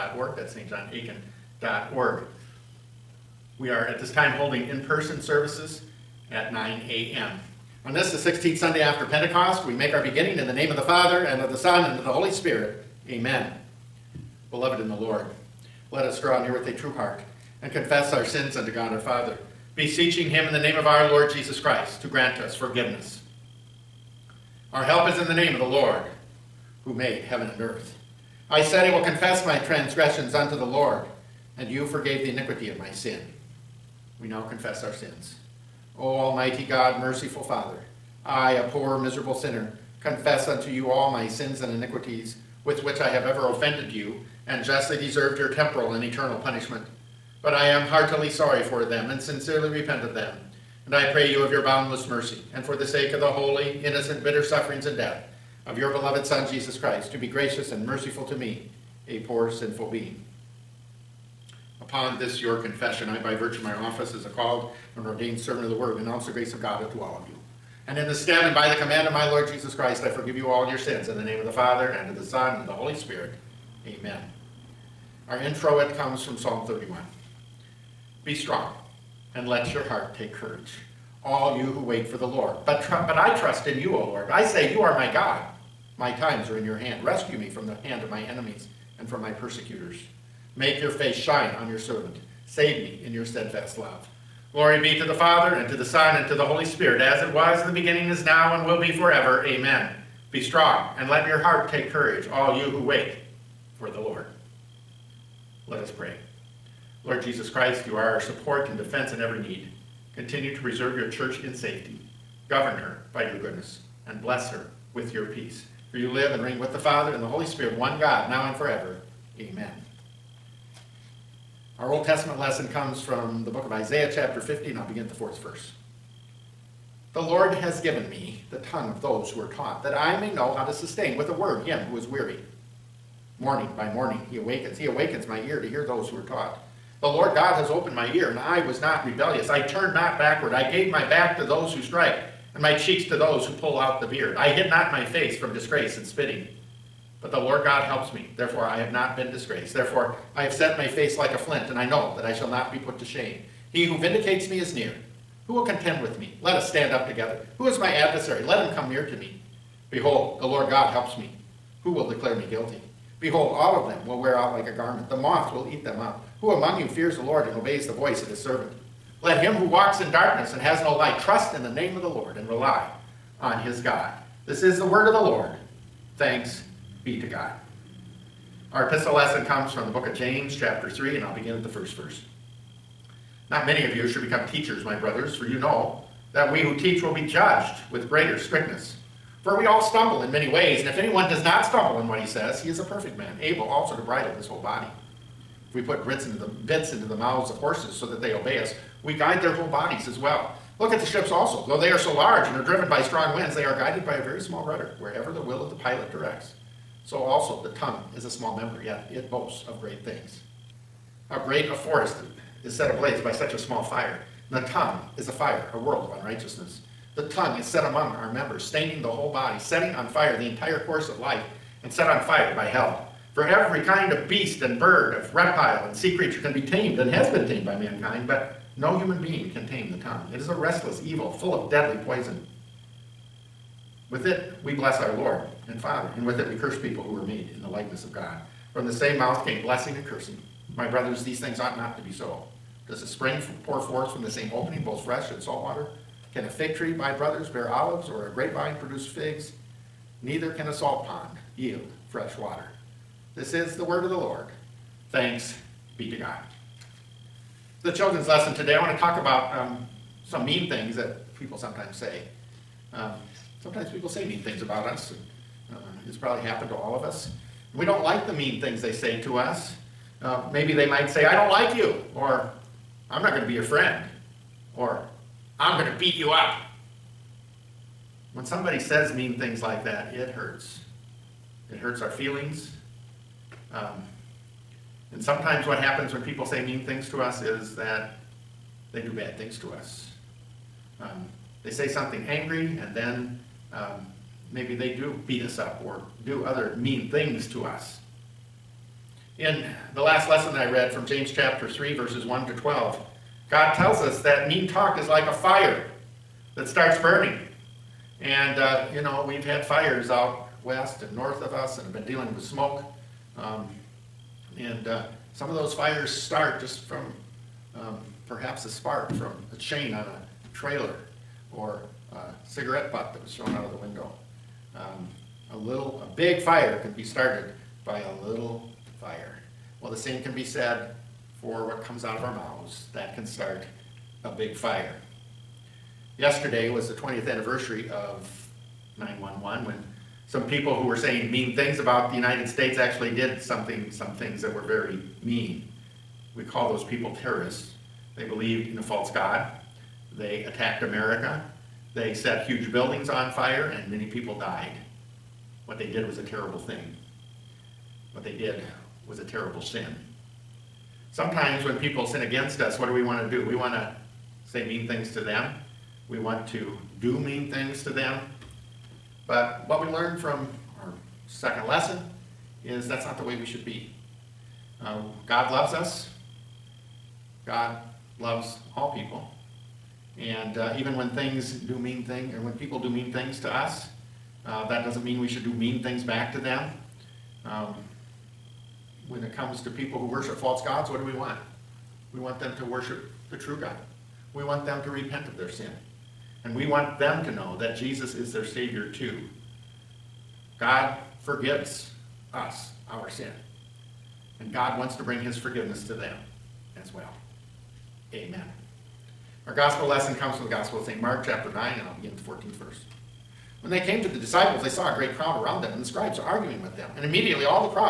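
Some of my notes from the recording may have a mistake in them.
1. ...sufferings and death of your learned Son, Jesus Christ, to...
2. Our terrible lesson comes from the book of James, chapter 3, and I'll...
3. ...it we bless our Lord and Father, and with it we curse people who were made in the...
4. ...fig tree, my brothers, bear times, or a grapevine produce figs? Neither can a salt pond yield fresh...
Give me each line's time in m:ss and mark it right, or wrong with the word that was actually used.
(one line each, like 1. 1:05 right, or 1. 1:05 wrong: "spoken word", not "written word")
1. 0:54 wrong: "beloved", not "learned"
2. 2:58 wrong: "epistle", not "terrible"
3. 3:54 right
4. 4:06 wrong: "olives", not "times".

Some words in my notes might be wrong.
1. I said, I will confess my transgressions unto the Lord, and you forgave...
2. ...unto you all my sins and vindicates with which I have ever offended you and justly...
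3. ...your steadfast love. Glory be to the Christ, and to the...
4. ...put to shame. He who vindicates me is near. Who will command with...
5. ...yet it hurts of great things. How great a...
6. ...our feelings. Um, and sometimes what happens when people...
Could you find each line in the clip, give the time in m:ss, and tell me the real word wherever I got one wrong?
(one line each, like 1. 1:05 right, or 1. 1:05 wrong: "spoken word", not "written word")
1. 0:28 right
2. 0:40 wrong: "iniquities", not "vindicates"
3. 1:33 wrong: "Father", not "Christ"
4. 2:32 wrong: "contend", not "command"
5. 3:28 wrong: "boasts", not "hurts"
6. 4:41 right.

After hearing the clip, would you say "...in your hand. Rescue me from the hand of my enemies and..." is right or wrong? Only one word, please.
right.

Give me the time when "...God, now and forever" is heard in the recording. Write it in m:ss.
1:57.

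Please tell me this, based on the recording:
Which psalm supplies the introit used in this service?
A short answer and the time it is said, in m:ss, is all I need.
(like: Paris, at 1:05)
Psalm 31, at 1:16.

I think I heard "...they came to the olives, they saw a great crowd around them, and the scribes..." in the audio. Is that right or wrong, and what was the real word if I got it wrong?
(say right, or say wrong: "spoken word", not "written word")
wrong: "disciples", not "olives".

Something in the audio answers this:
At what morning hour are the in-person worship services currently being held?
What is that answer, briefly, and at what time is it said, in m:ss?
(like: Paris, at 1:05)
9 a.m., at 0:06.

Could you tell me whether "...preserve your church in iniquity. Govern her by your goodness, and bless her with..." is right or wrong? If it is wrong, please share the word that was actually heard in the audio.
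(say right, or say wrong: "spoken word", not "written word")
wrong: "safety", not "iniquity".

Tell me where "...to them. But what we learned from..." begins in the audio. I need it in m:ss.
6:07.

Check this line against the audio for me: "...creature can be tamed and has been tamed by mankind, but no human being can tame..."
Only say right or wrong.
right.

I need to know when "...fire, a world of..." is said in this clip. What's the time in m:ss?
3:35.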